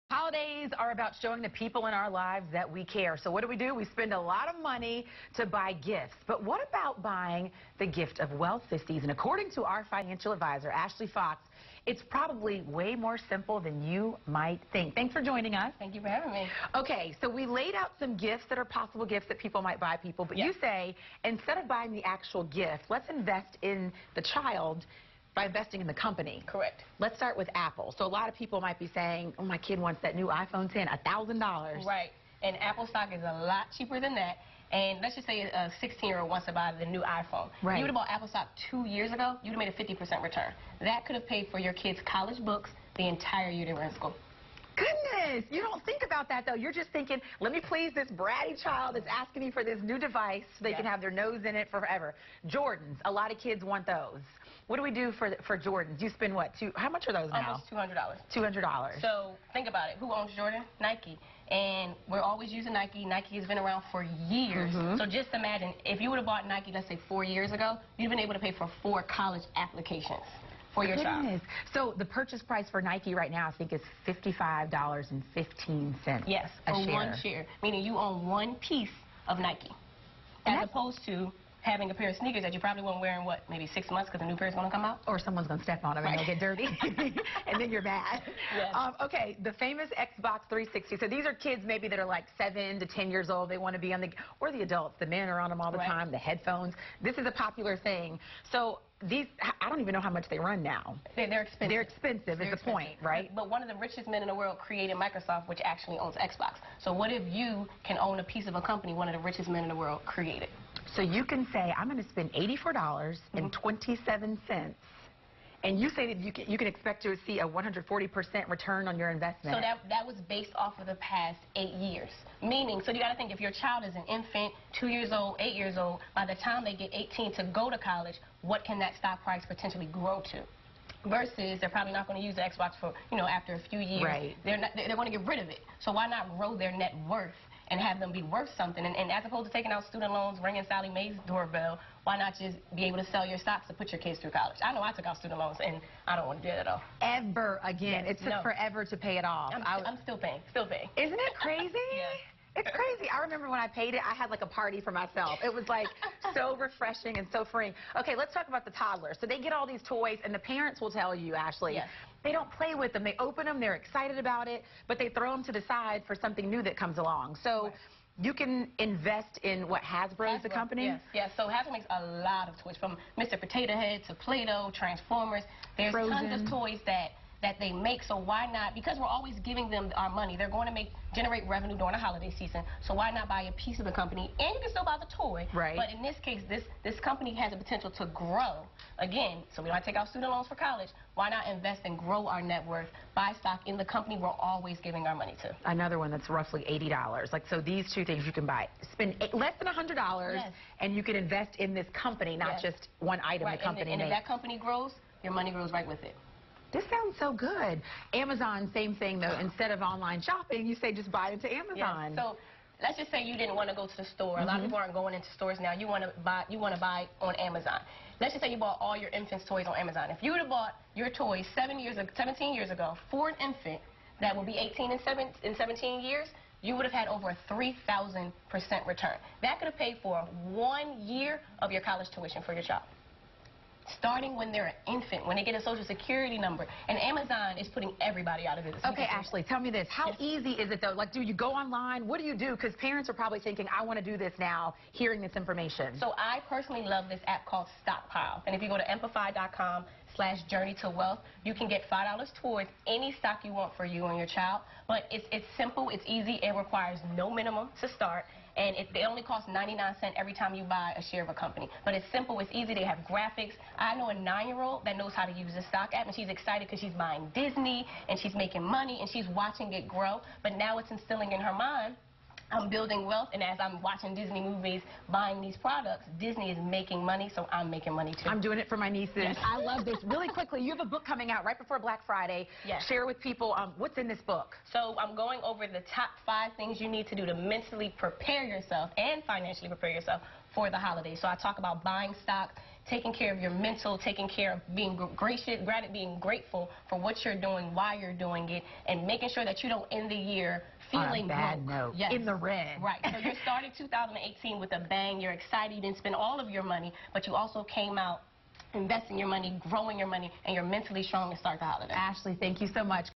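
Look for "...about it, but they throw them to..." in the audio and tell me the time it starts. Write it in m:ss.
2:44.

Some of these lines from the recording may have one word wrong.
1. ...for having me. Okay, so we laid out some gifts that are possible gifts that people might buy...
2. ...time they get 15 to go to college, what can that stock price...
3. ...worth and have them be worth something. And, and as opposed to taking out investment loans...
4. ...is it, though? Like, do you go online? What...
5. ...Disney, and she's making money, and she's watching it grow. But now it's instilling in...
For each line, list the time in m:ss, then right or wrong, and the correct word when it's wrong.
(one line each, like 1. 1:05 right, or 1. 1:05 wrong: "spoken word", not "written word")
1. 0:16 right
2. 2:06 wrong: "18", not "15"
3. 2:17 wrong: "student", not "investment"
4. 4:00 right
5. 4:27 right.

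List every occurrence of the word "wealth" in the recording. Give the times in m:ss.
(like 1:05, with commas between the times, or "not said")
0:08, 4:10, 4:33.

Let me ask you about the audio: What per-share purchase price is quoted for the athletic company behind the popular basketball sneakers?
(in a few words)
$55.15.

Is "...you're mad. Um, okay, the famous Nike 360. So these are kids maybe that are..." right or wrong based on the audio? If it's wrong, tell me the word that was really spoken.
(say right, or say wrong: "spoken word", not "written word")
wrong: "Xbox", not "Nike".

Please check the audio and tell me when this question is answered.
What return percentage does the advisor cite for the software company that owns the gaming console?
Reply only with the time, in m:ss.
1:57.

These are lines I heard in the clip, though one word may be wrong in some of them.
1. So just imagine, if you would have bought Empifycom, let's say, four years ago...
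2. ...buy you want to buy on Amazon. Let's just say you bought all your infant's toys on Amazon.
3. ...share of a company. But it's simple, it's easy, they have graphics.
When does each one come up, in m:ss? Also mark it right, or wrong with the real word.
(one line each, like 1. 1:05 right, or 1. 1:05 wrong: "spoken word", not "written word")
1. 1:04 wrong: "Nike", not "Empifycom"
2. 3:36 right
3. 4:21 right.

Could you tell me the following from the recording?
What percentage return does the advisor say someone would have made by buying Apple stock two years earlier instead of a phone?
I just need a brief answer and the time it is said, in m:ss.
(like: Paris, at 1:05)
50%, at 0:40.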